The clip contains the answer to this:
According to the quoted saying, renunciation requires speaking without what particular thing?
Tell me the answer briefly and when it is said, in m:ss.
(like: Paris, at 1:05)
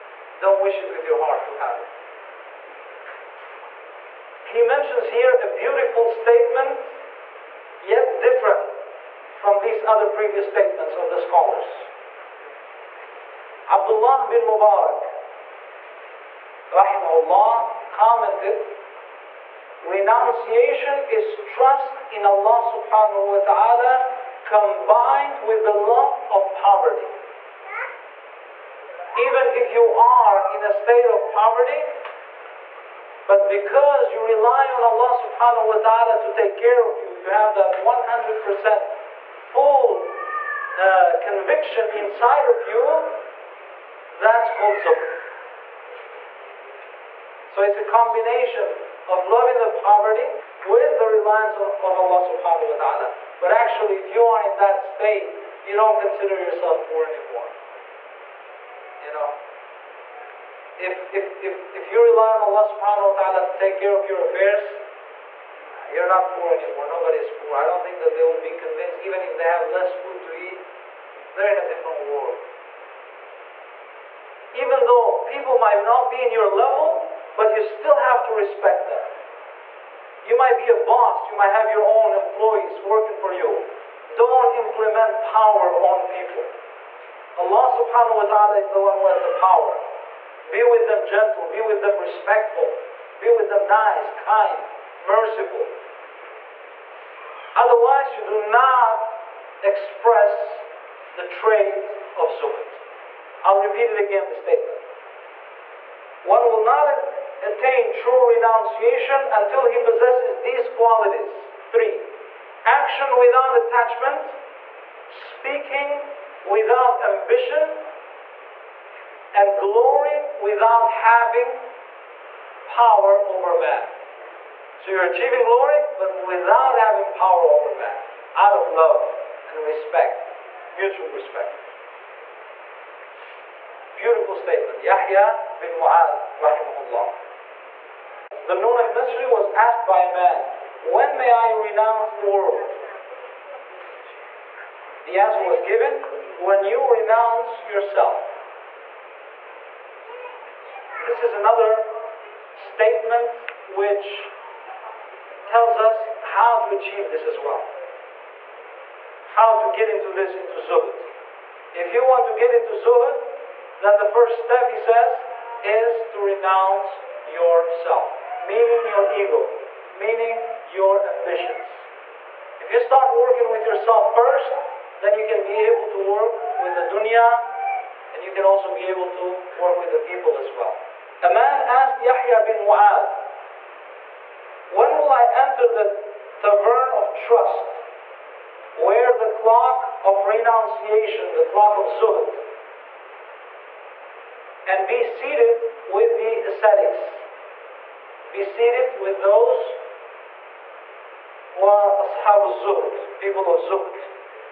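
Ambition, at 1:55.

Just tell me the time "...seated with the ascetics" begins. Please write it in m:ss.
3:15.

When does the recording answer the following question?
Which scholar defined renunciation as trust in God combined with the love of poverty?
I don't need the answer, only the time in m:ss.
0:13.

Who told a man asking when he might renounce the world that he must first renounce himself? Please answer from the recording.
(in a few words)
Dhu'n-Nun al-Misri.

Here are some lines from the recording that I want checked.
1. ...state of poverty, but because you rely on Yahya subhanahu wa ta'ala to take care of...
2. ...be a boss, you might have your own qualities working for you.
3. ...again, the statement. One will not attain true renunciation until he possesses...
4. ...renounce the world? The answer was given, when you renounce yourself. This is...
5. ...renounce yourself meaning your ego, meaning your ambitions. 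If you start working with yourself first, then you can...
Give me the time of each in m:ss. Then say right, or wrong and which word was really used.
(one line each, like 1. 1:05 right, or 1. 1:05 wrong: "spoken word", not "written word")
1. 0:30 wrong: "Allah", not "Yahya"
2. 1:20 wrong: "employees", not "qualities"
3. 1:43 right
4. 2:21 right
5. 2:46 right.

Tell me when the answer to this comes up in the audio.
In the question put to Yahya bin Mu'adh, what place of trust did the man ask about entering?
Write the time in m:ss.
3:06.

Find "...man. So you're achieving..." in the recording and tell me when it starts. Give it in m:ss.
2:03.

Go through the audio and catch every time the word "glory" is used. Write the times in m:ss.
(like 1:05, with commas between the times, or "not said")
1:59, 2:05.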